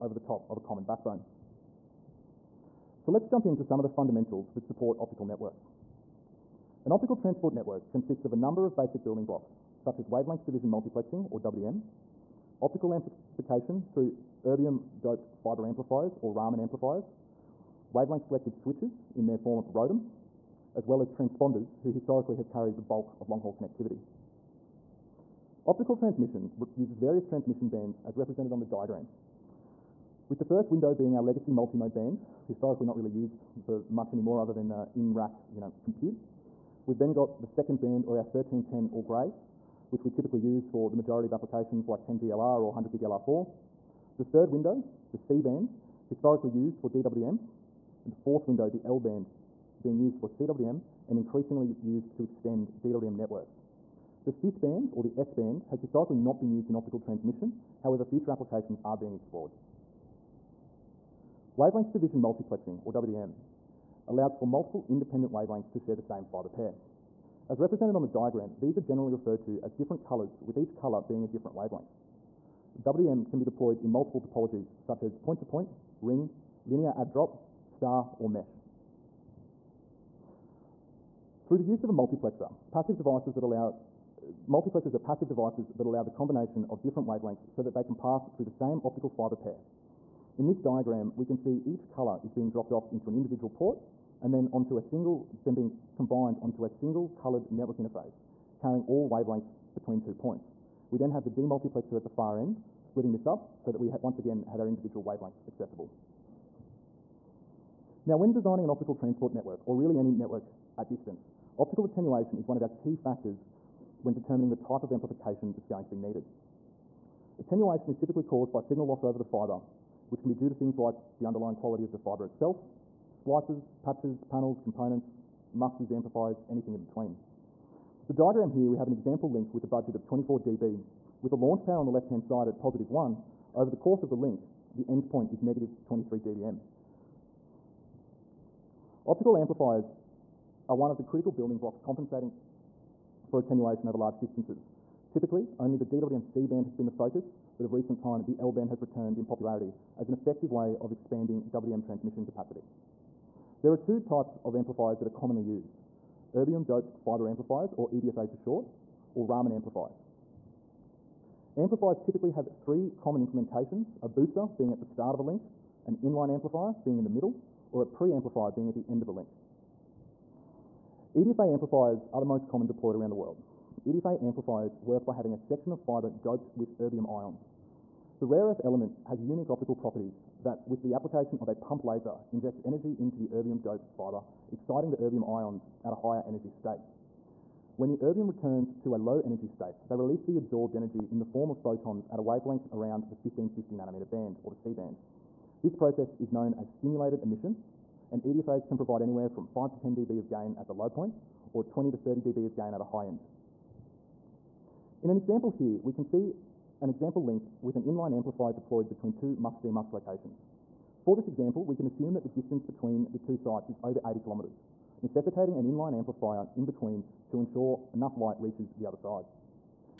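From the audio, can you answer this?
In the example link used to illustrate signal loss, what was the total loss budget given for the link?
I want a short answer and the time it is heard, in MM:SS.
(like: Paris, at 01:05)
24 dB, at 02:10.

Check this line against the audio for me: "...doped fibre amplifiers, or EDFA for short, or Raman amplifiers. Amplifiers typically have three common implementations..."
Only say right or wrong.
right.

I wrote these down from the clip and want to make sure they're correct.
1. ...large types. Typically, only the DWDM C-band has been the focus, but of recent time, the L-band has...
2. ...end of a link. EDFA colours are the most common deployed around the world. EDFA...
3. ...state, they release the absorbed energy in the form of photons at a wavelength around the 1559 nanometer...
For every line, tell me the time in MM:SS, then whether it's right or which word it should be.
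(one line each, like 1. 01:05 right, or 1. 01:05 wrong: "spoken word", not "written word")
1. 02:23 wrong: "distances", not "types"
2. 02:48 wrong: "amplifiers", not "colours"
3. 03:09 wrong: "1550", not "1559".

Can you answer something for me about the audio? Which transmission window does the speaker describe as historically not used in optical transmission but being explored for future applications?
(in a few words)
S band.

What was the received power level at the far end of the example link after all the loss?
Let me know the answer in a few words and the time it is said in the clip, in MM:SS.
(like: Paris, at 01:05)
-23 dBm, at 02:15.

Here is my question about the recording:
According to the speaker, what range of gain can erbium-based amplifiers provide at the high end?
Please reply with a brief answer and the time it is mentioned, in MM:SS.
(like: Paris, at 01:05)
20 to 30 dB, at 03:21.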